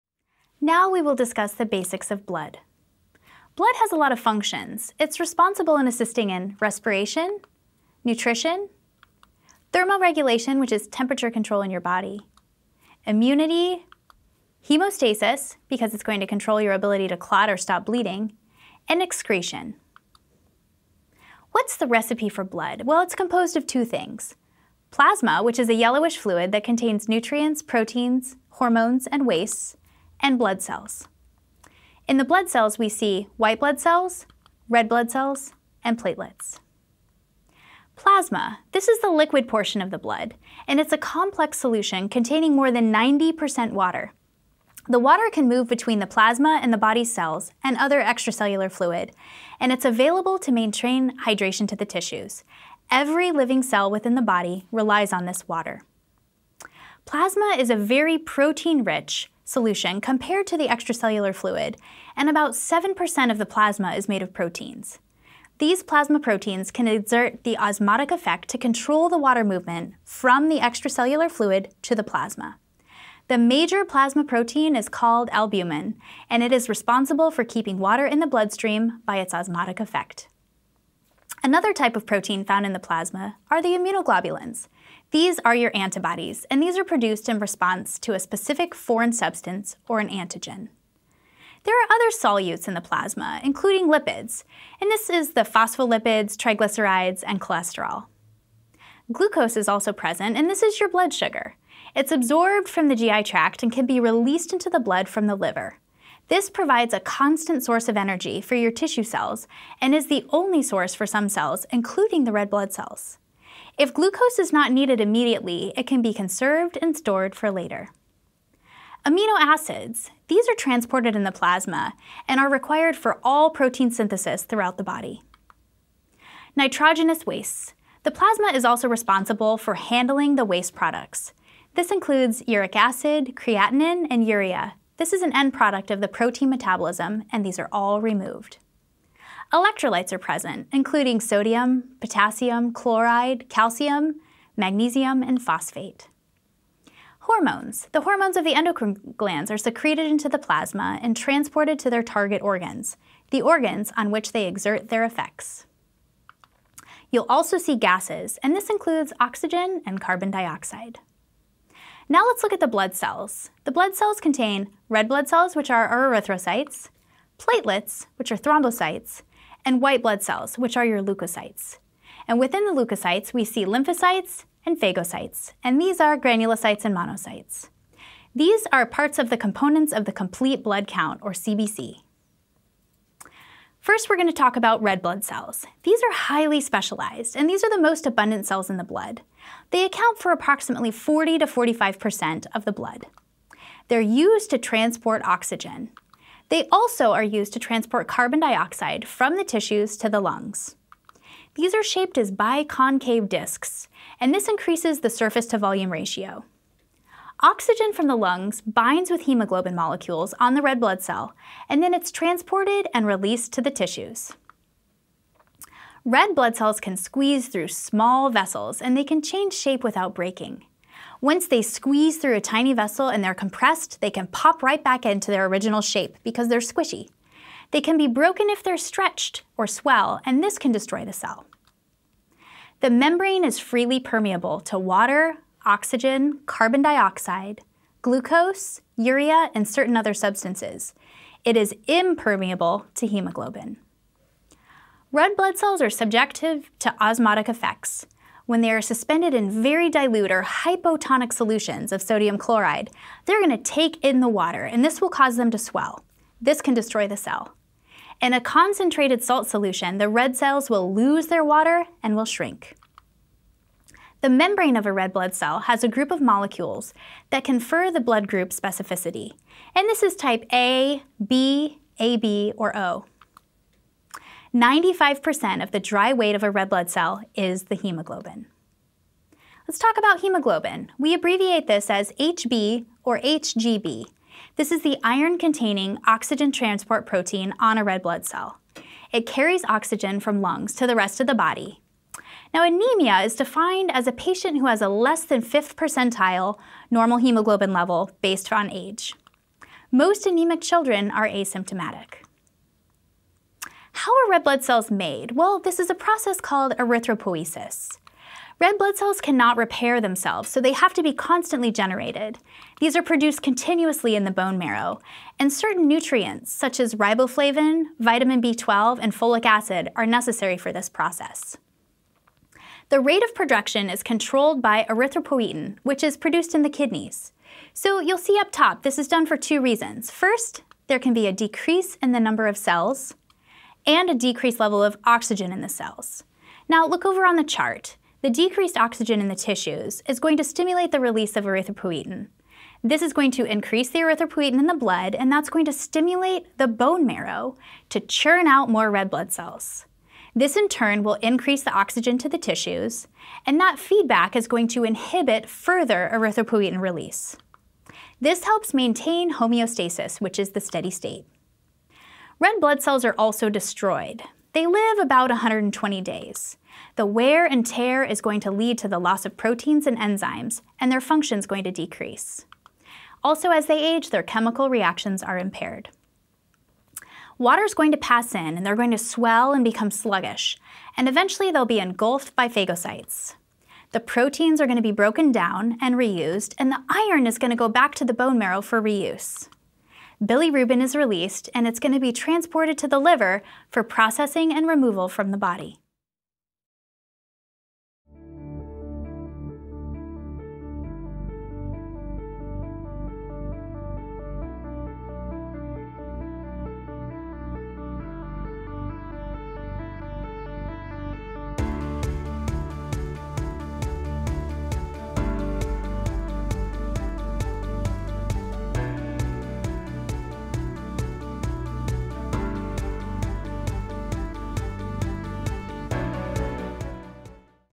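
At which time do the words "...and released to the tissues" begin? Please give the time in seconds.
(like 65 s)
212 s.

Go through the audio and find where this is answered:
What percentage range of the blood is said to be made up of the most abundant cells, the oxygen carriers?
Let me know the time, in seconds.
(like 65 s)
190 s.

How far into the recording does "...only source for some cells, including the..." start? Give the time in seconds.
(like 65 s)
110 s.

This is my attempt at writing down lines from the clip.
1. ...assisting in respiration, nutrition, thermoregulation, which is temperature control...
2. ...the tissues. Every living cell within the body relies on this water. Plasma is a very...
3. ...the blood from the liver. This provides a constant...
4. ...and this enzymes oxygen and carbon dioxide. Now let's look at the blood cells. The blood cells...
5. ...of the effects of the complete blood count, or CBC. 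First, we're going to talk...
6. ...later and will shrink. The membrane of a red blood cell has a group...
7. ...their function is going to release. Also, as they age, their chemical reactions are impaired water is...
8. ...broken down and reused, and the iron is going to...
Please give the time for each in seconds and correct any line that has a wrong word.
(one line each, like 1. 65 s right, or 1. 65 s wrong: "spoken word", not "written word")
1. 5 s right
2. 51 s right
3. 104 s right
4. 158 s wrong: "includes", not "enzymes"
5. 179 s wrong: "components", not "effects"
6. 261 s wrong: "water", not "later"
7. 370 s wrong: "decrease", not "release"
8. 384 s right.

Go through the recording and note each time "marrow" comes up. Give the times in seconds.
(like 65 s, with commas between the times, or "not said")
314 s, 347 s, 388 s.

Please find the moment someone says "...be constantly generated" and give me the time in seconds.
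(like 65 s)
311 s.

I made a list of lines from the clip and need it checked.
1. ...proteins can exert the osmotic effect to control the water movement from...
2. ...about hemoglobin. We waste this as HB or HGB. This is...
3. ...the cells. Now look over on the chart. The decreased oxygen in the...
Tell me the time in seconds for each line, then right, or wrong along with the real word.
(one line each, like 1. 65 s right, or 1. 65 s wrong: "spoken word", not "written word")
1. 66 s right
2. 279 s wrong: "abbreviate", not "waste"
3. 335 s right.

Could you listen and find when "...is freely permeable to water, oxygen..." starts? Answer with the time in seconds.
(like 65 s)
233 s.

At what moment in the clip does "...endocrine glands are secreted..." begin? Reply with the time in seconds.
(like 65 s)
148 s.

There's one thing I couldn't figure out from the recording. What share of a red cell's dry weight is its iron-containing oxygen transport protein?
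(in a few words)
95%.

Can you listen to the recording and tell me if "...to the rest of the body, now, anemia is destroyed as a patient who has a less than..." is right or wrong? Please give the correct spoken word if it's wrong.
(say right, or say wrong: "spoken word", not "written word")
wrong: "defined", not "destroyed".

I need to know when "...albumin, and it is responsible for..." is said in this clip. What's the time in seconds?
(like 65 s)
75 s.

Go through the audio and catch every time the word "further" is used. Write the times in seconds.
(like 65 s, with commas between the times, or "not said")
355 s.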